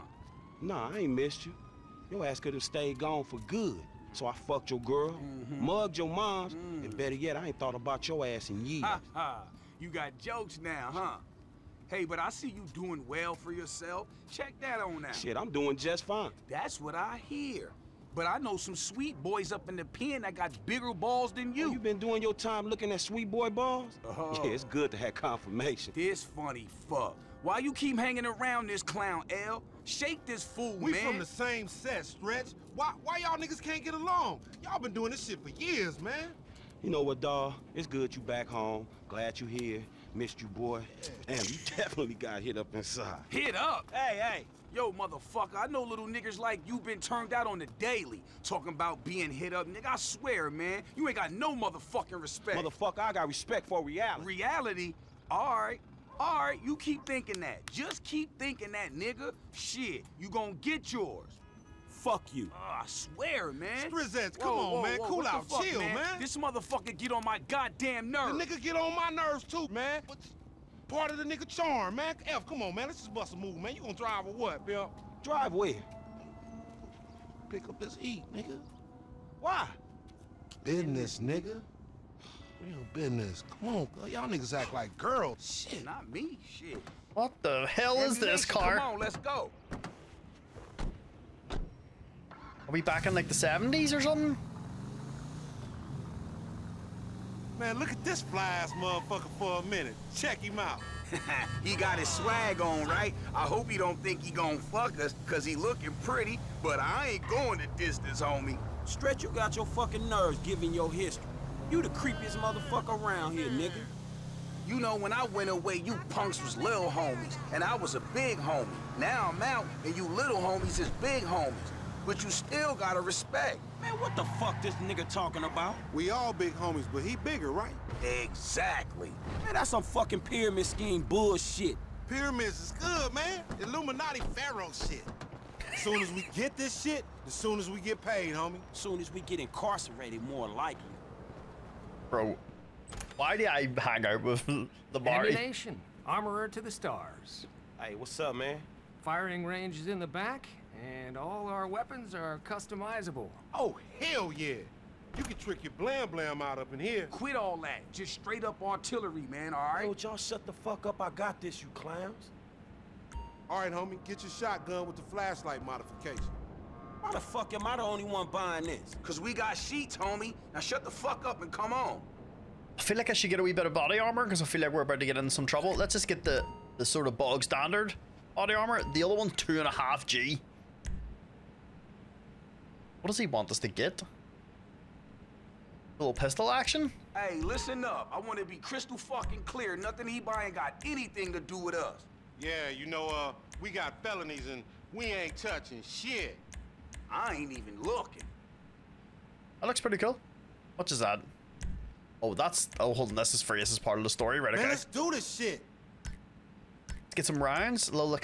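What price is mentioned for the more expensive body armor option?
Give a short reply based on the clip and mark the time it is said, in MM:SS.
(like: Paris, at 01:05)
2.5G, at 02:59.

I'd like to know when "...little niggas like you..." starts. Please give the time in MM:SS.
00:45.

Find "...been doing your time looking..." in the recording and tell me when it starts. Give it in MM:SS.
00:21.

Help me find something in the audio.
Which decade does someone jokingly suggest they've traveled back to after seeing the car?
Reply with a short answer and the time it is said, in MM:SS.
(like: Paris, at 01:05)
the 70s, at 01:33.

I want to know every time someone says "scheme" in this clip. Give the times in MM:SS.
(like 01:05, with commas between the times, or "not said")
02:10.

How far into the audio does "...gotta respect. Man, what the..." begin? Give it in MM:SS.
02:02.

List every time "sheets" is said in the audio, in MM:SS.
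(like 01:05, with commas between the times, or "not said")
02:49.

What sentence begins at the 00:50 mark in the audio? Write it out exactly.
You ain't got no motherfucking respect.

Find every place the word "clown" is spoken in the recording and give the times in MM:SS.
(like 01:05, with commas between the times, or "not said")
00:28, 02:41.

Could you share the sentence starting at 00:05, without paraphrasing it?
mugged your moms, mm and better yet, I ain't thought about your ass in years.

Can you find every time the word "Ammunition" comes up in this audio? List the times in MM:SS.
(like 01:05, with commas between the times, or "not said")
02:25.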